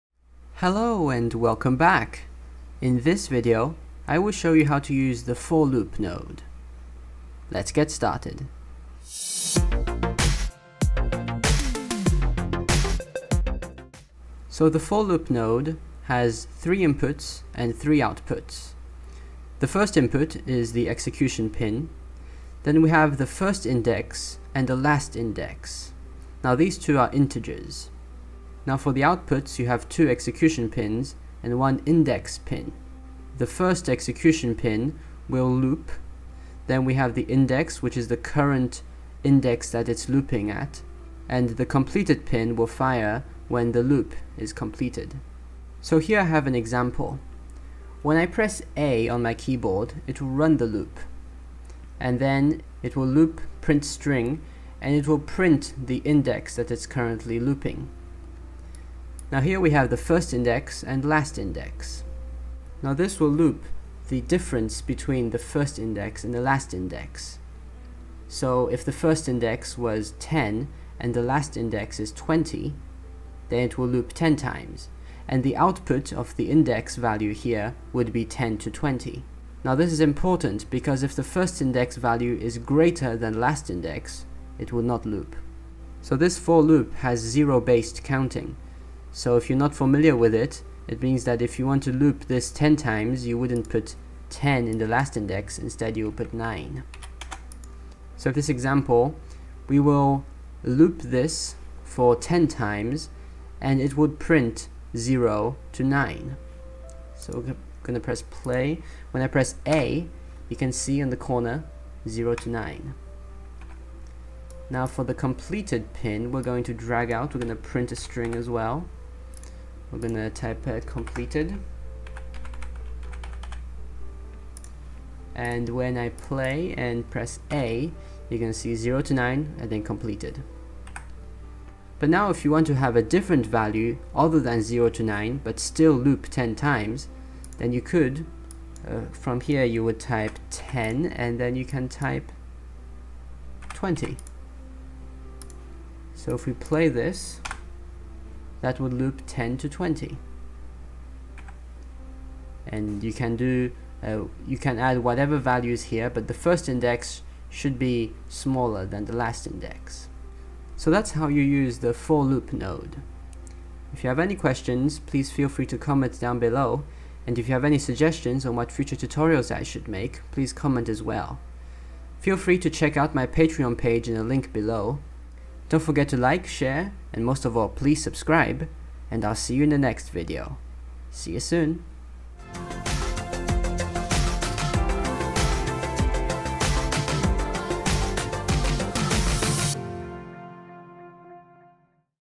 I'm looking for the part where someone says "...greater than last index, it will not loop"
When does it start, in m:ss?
1:22.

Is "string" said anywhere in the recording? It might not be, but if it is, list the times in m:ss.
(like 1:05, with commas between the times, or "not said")
0:53, 1:57.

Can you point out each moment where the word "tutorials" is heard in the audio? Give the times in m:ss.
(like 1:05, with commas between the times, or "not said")
2:48.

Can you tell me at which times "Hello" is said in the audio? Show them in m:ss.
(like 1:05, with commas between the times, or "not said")
0:00.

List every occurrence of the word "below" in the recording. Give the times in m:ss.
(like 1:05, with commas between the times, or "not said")
2:46, 2:54.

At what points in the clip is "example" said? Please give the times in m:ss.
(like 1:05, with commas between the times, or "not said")
0:46, 1:38.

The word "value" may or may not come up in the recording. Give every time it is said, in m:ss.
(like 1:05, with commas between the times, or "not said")
1:16, 1:21, 2:13, 2:35.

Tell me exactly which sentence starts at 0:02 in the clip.
In this video, I will show you how to use the for loop node.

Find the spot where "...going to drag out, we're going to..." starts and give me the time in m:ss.
1:56.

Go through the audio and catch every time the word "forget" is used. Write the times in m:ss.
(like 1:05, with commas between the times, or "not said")
2:55.